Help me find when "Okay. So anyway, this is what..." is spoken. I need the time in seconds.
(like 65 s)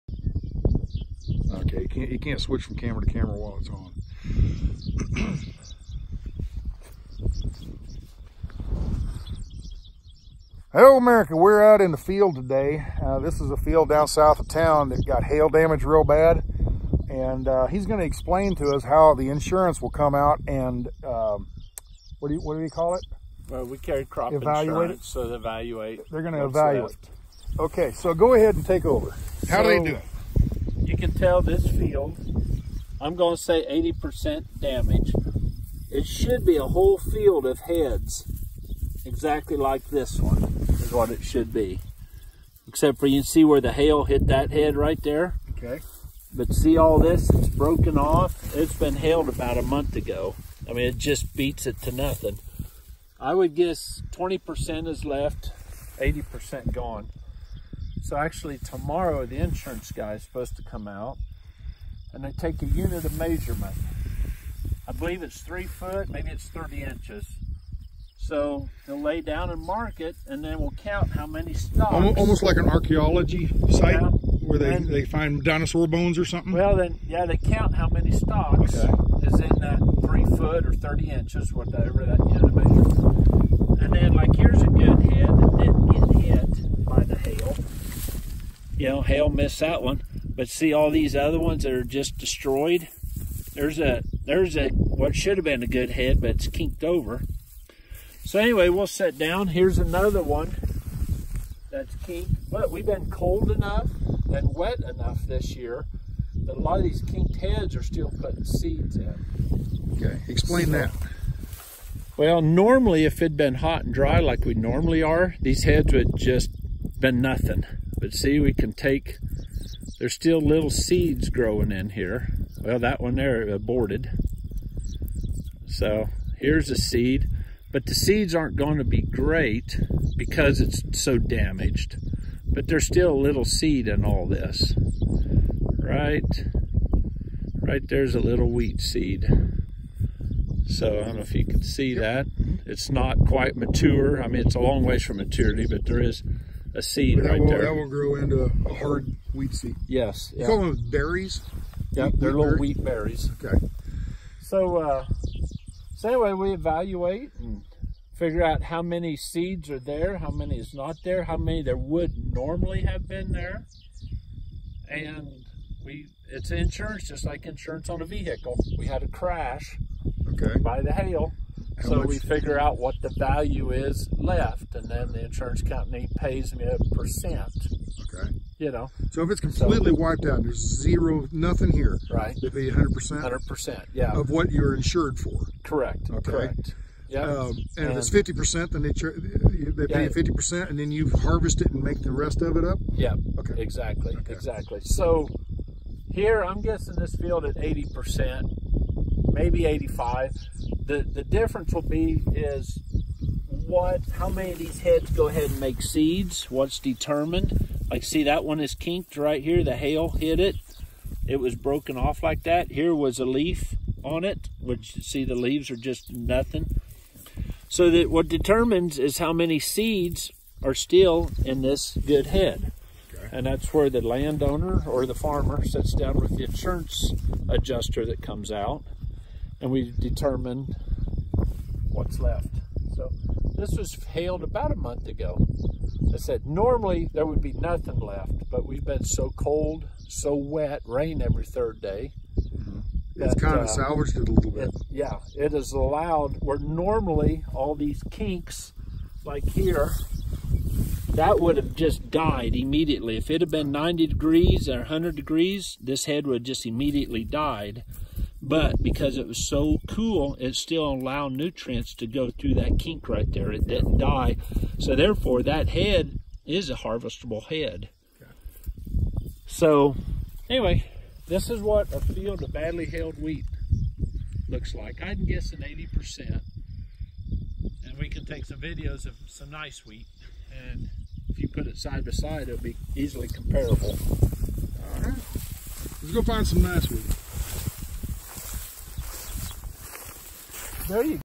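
268 s.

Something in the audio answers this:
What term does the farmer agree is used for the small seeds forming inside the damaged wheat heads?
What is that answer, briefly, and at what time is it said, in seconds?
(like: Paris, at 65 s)
wheat berries, at 152 s.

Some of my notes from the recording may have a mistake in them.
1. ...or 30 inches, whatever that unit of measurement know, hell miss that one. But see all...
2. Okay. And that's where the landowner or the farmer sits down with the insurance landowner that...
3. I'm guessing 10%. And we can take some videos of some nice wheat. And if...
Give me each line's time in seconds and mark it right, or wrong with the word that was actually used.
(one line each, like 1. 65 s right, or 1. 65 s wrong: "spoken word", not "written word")
1. 80 s right
2. 223 s wrong: "adjuster", not "landowner"
3. 275 s wrong: "80", not "10".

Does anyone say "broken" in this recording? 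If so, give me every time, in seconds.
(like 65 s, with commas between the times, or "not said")
47 s, 211 s.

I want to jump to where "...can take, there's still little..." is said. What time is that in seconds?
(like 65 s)
118 s.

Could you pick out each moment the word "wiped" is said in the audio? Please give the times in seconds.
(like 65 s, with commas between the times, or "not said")
180 s.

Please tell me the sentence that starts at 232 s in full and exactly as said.
So this was hailed about a month ago.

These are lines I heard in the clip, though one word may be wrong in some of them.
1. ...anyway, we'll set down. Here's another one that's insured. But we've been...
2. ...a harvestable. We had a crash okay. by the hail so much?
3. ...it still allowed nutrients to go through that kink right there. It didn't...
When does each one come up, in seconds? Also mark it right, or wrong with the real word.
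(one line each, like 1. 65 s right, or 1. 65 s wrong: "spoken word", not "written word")
1. 98 s wrong: "kinked", not "insured"
2. 168 s wrong: "vehicle", not "harvestable"
3. 260 s right.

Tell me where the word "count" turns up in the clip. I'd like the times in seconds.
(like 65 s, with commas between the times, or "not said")
70 s, 77 s.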